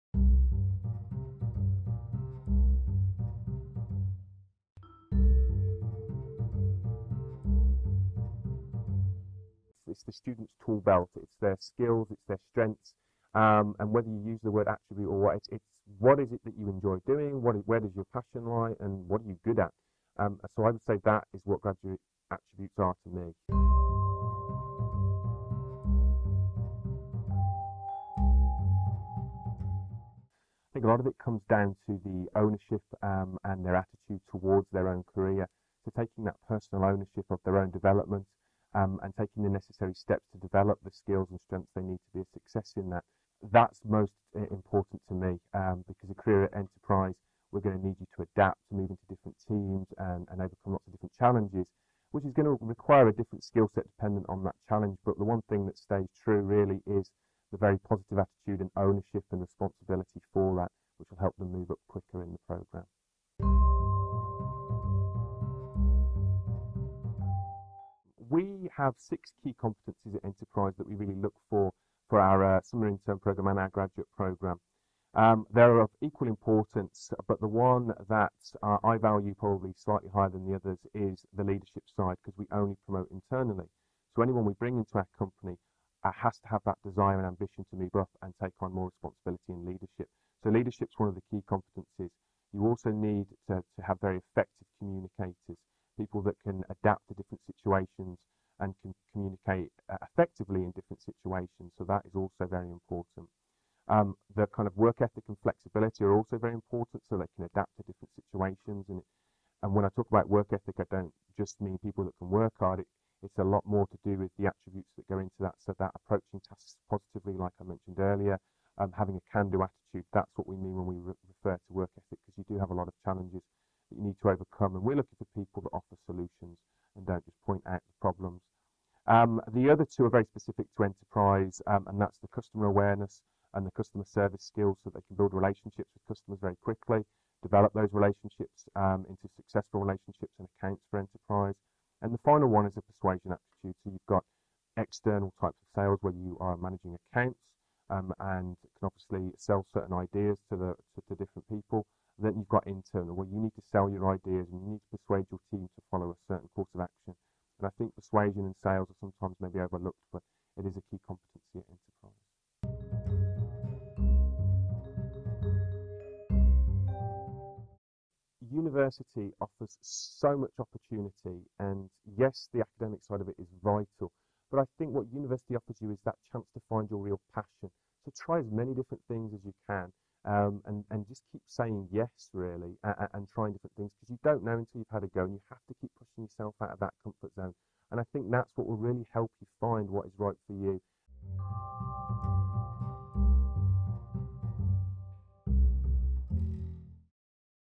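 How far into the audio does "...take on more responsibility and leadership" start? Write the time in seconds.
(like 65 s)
88 s.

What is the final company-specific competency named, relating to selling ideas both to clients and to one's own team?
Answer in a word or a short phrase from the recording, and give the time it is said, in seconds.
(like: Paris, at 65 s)
persuasion aptitude, at 142 s.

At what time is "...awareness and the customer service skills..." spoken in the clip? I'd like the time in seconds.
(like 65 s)
132 s.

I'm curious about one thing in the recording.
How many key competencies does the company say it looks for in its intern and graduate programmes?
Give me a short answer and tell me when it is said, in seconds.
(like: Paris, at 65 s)
6, at 68 s.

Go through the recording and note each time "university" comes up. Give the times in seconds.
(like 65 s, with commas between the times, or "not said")
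168 s, 175 s.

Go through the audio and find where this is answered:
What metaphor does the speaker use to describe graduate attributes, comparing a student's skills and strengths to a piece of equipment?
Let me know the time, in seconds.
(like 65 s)
10 s.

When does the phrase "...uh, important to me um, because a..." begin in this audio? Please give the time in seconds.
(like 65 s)
44 s.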